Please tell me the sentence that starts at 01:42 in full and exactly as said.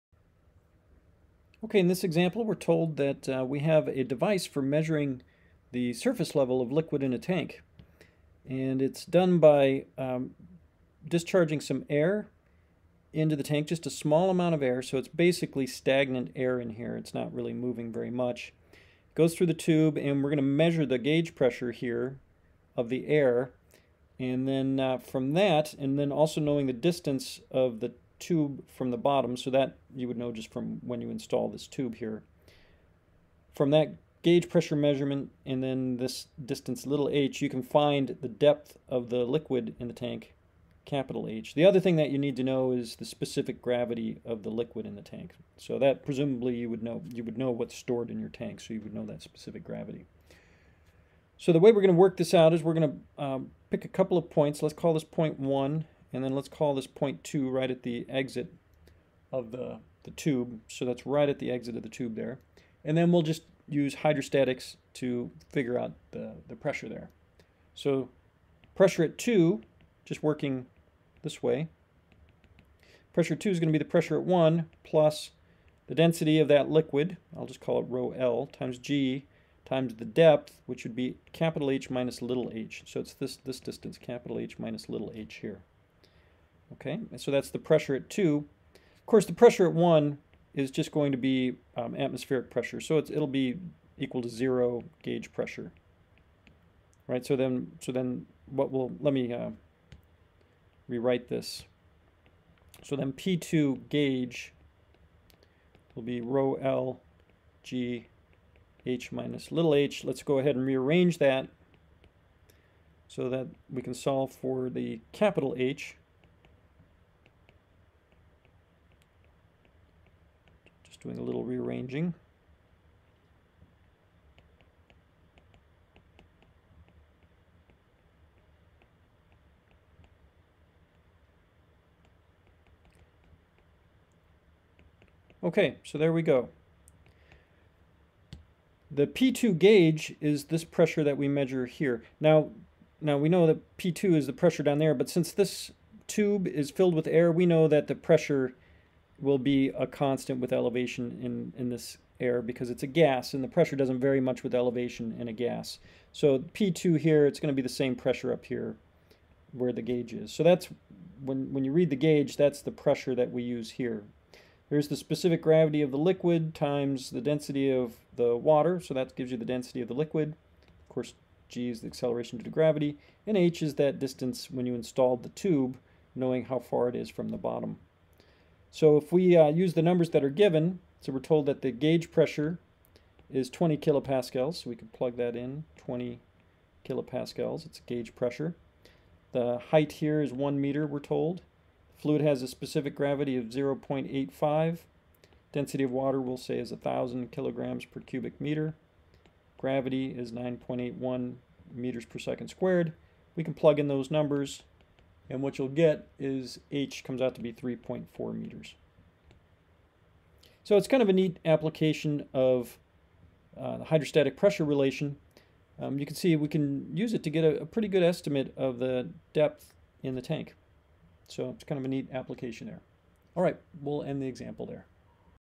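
So then P2 gauge will be rho L G H minus little h.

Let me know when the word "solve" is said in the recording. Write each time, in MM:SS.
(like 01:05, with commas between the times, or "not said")
01:53.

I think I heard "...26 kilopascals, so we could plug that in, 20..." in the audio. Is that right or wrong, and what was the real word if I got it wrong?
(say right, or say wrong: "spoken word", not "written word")
wrong: "20", not "26".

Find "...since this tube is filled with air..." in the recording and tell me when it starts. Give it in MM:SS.
02:25.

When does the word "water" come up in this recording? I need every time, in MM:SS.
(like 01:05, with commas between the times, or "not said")
02:48, 03:15.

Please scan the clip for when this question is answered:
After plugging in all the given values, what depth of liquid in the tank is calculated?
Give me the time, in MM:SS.
03:27.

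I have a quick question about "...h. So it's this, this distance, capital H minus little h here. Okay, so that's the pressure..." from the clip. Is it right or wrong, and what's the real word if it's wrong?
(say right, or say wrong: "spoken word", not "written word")
right.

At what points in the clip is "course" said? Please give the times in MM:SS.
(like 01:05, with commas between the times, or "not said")
01:29, 02:50.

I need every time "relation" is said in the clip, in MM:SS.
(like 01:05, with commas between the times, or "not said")
03:34.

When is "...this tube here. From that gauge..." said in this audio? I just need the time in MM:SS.
00:31.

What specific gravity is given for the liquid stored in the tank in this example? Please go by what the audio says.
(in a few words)
0.85.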